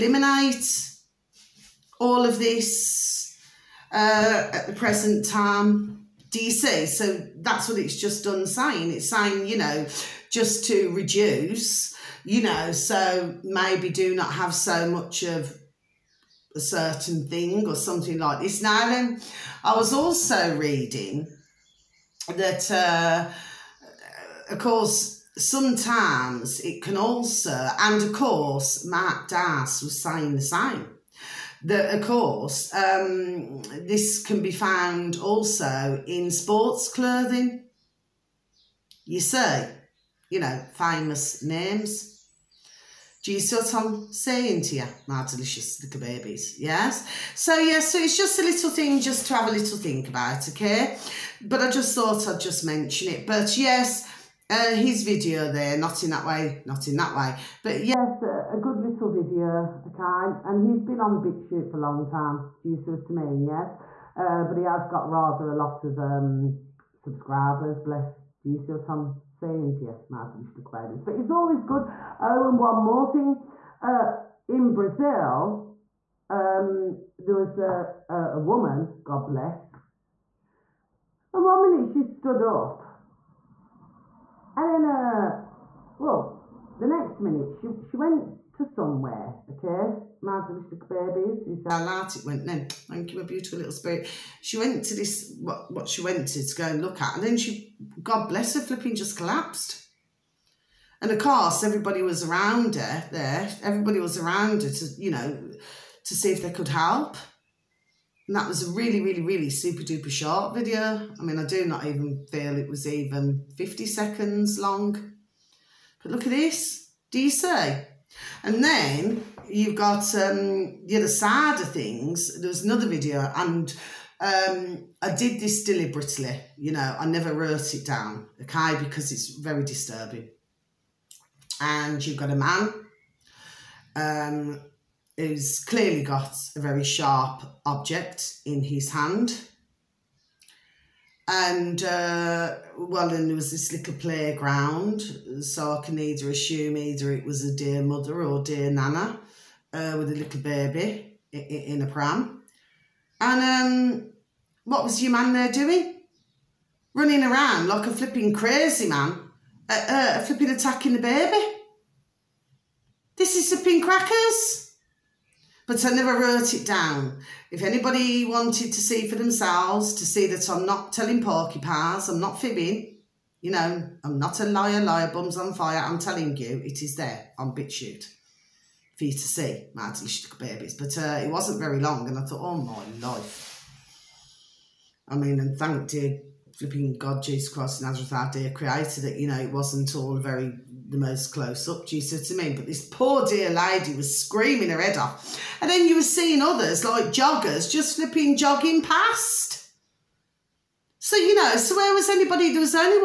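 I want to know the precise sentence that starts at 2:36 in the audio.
Running around like a flipping crazy man, uh, uh, flipping attacking the baby.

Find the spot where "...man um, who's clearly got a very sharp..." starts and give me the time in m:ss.
2:12.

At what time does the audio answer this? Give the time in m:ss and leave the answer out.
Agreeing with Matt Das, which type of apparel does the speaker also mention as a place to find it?
0:36.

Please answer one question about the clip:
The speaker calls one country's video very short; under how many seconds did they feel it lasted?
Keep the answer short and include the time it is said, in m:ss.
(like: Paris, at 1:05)
50, at 1:53.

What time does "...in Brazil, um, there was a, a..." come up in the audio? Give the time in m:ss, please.
1:14.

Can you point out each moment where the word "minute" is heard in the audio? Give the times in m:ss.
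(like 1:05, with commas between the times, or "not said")
1:21, 1:27.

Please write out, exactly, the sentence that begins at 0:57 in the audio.
But yes, a, a good little video, okay?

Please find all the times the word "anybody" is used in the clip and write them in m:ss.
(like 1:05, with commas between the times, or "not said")
2:47, 3:22.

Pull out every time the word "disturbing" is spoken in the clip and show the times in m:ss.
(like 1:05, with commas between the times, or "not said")
2:09.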